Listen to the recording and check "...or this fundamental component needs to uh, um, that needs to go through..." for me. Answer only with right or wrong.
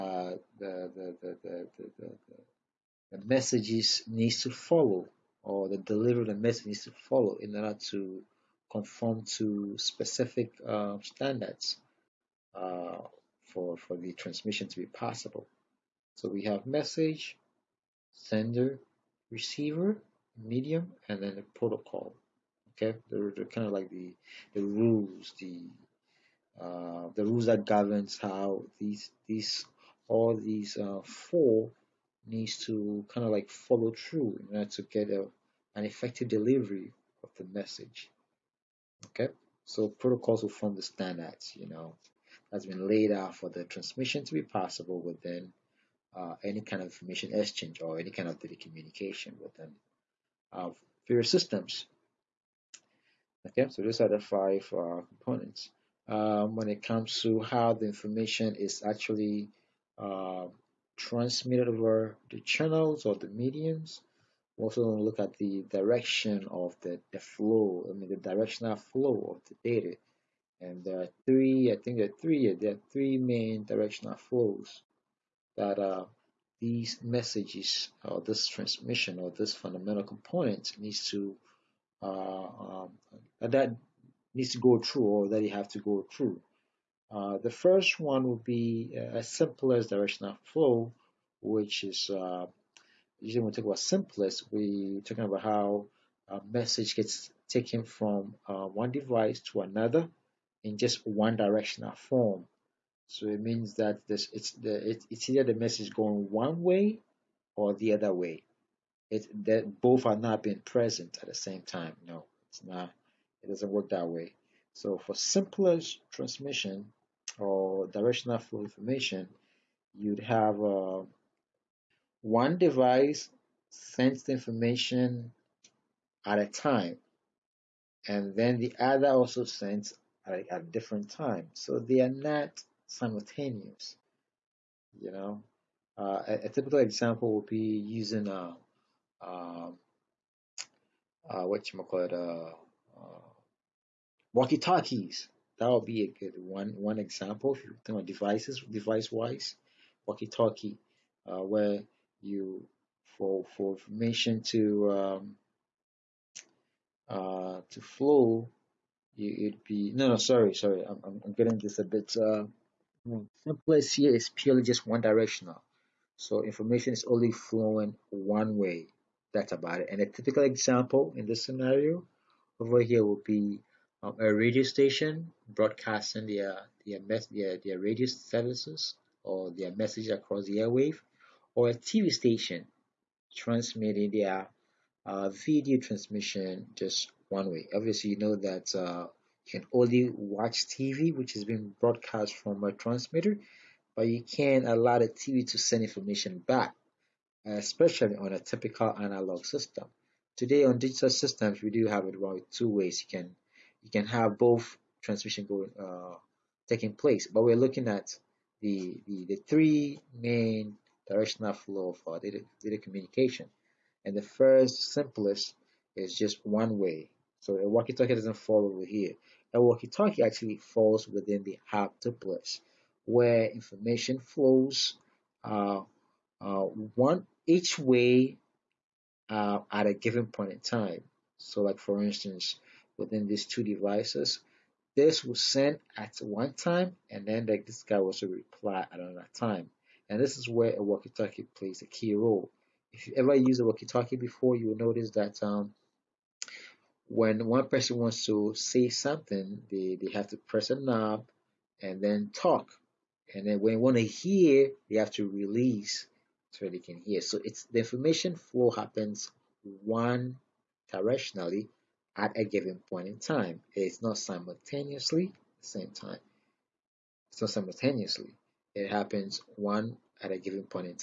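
right.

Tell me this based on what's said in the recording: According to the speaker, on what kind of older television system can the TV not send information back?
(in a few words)
analog system.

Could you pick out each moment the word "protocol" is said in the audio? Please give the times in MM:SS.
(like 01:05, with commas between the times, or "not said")
00:21, 00:39.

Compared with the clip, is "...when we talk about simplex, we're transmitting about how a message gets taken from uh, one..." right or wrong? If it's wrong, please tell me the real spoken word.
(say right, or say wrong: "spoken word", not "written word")
wrong: "talking", not "transmitting".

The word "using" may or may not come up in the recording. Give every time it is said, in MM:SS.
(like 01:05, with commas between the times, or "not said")
02:17.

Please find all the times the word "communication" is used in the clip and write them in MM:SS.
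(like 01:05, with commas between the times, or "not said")
00:48, 03:32.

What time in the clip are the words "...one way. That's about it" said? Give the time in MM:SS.
02:48.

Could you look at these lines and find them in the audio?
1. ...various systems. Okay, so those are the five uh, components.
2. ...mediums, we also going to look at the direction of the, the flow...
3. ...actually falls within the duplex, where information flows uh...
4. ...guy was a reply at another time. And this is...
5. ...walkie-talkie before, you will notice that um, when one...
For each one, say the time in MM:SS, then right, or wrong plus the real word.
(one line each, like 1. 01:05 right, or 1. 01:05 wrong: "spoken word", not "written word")
1. 00:51 right
2. 01:03 right
3. 03:40 right
4. 03:57 right
5. 04:03 right.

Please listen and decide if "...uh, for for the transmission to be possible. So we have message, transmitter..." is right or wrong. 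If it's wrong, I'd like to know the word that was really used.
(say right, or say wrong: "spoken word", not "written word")
wrong: "sender", not "transmitter".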